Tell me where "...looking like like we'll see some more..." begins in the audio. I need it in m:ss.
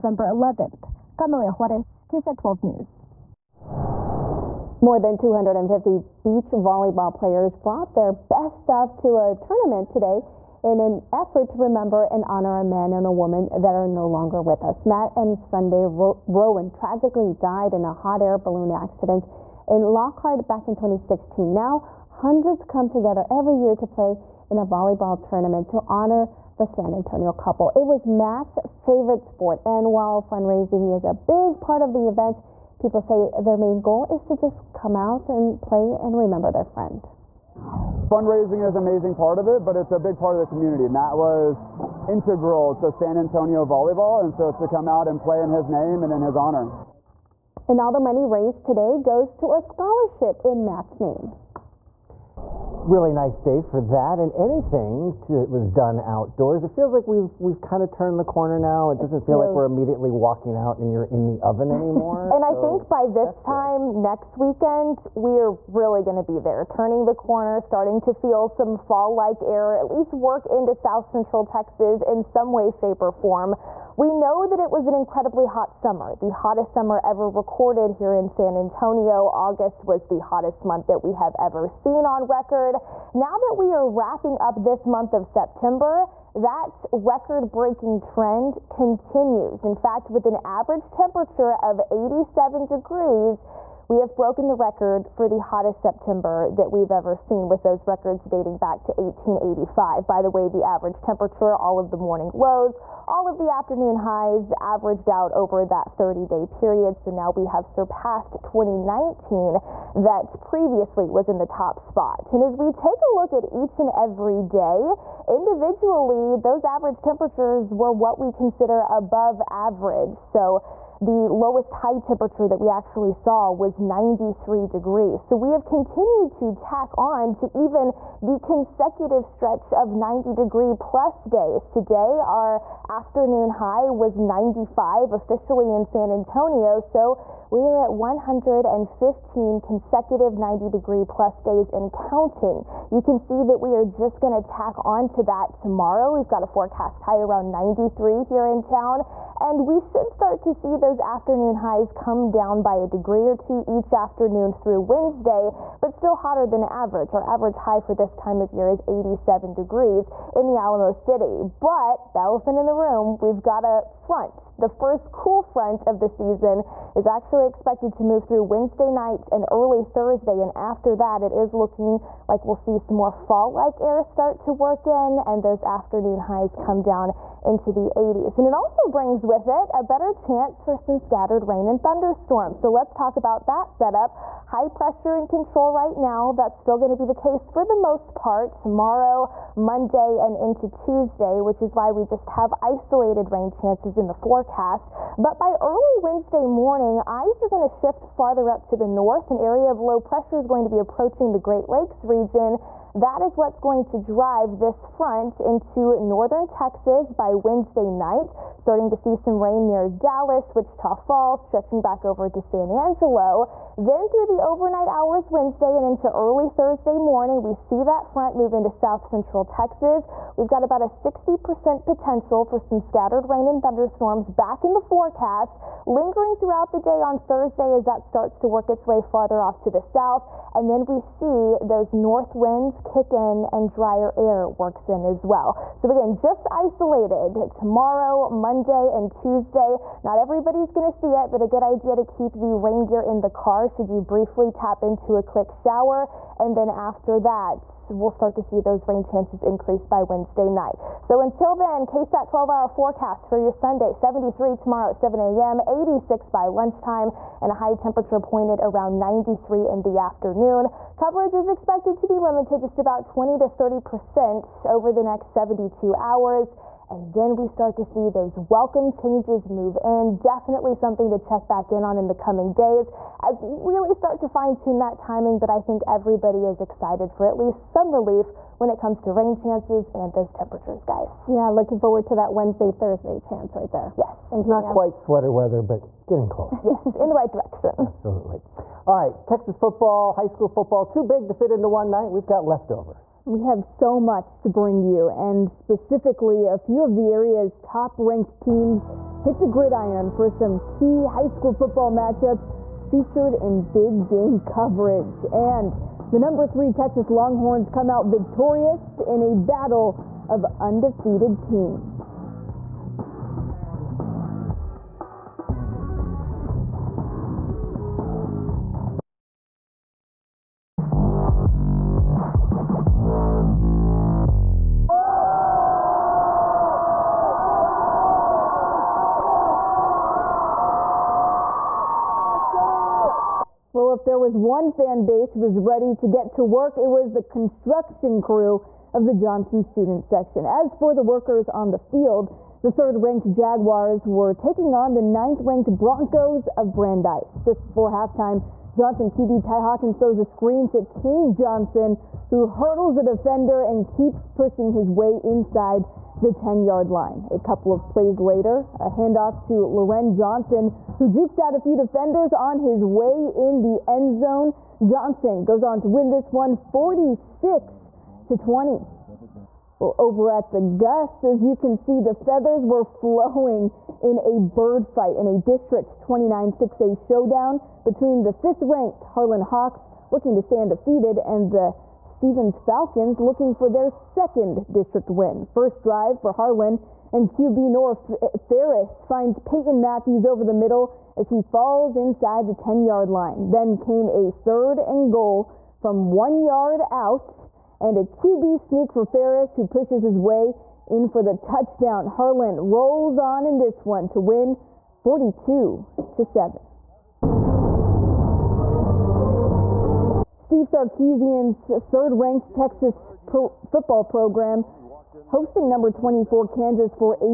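2:51.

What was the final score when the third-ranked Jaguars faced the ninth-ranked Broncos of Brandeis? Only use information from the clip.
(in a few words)
46 to 20.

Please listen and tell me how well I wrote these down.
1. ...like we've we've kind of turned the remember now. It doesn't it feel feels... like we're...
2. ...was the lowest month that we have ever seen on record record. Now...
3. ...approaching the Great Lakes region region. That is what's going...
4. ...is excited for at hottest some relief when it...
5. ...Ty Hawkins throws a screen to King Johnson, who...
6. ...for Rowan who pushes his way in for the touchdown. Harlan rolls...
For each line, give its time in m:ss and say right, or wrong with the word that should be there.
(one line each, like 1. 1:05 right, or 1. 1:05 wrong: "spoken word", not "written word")
1. 0:56 wrong: "corner", not "remember"
2. 1:19 wrong: "hottest", not "lowest"
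3. 3:20 right
4. 4:36 wrong: "least", not "hottest"
5. 5:49 right
6. 6:38 wrong: "Ferris", not "Rowan".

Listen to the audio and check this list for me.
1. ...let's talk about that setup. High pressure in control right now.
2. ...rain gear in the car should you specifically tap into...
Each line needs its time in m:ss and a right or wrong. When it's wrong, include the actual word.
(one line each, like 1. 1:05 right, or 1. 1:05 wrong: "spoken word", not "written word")
1. 3:02 right
2. 4:02 wrong: "briefly", not "specifically".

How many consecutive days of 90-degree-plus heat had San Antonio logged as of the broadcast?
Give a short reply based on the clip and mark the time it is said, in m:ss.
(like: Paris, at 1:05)
115, at 2:17.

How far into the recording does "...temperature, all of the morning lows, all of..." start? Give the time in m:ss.
1:41.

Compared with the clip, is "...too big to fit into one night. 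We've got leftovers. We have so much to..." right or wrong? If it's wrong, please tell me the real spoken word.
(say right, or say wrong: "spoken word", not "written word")
right.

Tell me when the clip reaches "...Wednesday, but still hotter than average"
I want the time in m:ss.
2:34.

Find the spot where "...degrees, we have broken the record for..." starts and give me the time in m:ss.
1:32.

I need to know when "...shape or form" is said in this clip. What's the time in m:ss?
1:12.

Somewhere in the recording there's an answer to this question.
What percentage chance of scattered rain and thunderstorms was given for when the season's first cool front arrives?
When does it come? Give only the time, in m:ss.
3:40.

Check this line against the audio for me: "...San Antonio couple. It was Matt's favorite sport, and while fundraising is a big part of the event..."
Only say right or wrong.
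right.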